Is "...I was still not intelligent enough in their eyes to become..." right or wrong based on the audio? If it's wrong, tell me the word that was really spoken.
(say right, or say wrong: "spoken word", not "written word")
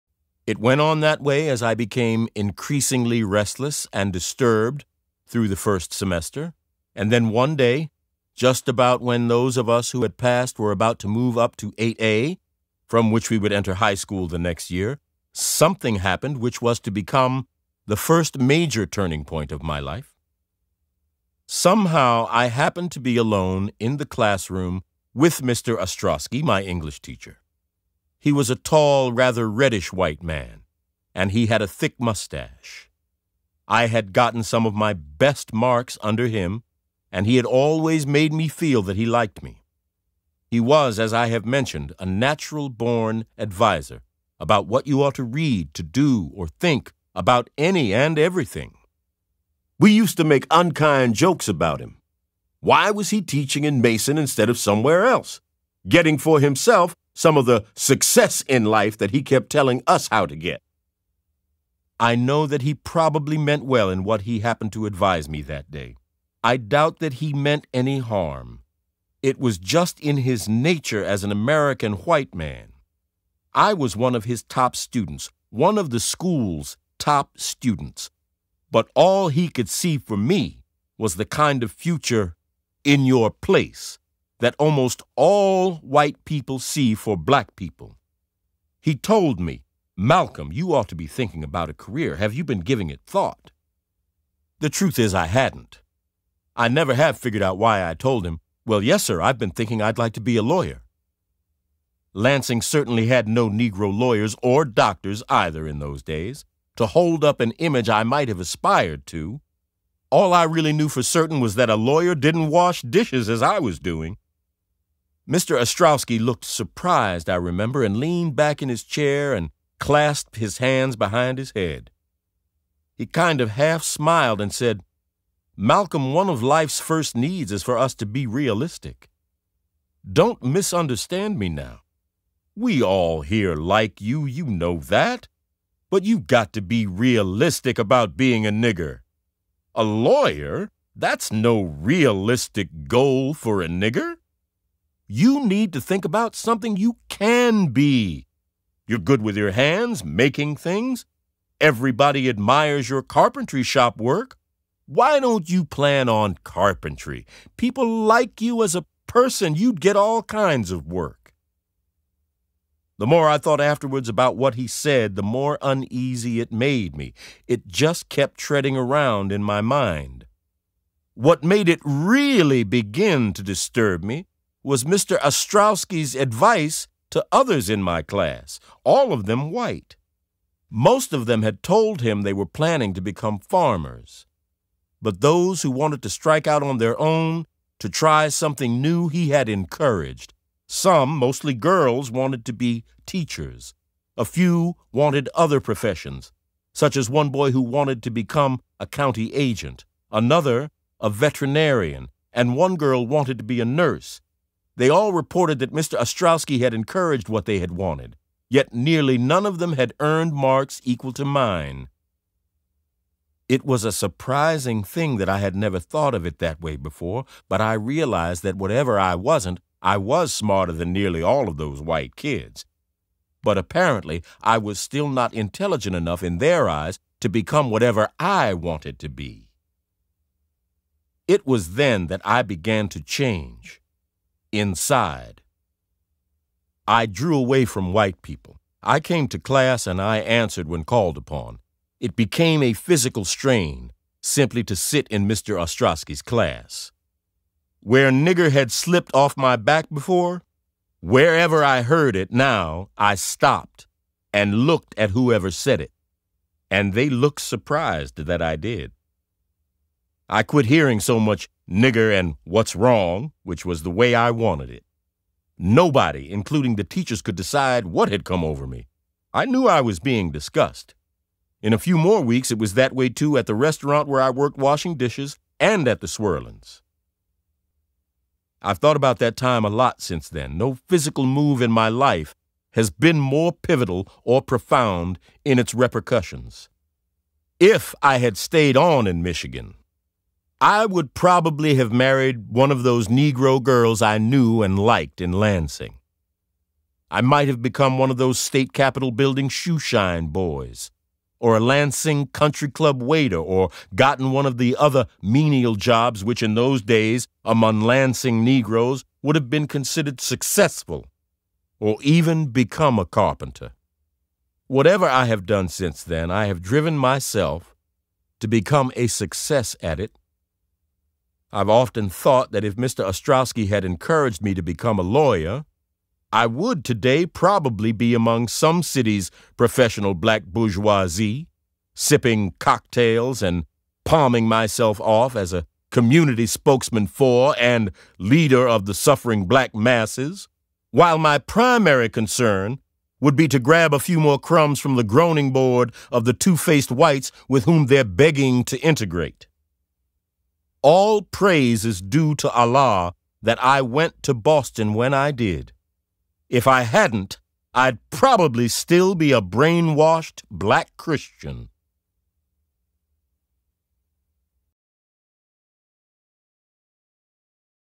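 right.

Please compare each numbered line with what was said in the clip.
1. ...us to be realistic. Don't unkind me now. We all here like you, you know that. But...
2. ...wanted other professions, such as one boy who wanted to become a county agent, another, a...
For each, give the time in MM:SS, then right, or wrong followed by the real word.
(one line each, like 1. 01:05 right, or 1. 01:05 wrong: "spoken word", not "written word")
1. 02:07 wrong: "misunderstand", not "unkind"
2. 03:14 right.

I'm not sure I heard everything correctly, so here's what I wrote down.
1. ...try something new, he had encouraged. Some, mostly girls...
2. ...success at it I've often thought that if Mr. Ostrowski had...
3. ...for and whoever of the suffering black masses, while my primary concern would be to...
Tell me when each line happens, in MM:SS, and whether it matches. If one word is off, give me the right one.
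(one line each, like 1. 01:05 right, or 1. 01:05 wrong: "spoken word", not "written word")
1. 03:07 right
2. 05:19 right
3. 05:37 wrong: "leader", not "whoever".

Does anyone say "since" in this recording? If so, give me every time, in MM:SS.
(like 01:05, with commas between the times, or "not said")
04:40, 05:15.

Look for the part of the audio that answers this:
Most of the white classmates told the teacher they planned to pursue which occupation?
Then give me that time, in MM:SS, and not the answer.
03:03.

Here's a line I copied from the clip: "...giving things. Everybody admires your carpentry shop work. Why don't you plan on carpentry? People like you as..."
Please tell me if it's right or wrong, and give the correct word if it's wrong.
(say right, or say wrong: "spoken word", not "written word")
wrong: "making", not "giving".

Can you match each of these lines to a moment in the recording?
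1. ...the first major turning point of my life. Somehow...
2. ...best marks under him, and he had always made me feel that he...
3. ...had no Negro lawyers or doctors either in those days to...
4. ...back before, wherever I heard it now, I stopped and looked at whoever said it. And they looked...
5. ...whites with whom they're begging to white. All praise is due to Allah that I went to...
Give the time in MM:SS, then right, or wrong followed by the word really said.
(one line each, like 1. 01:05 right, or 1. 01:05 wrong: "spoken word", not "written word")
1. 00:17 right
2. 00:34 right
3. 01:43 right
4. 04:09 right
5. 05:46 wrong: "integrate", not "white".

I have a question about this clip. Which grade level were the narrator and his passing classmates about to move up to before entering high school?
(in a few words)
8A.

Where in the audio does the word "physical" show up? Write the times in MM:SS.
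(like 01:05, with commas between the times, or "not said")
04:02, 04:40.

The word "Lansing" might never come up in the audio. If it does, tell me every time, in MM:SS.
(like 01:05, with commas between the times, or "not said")
01:42, 04:55, 05:01, 05:07.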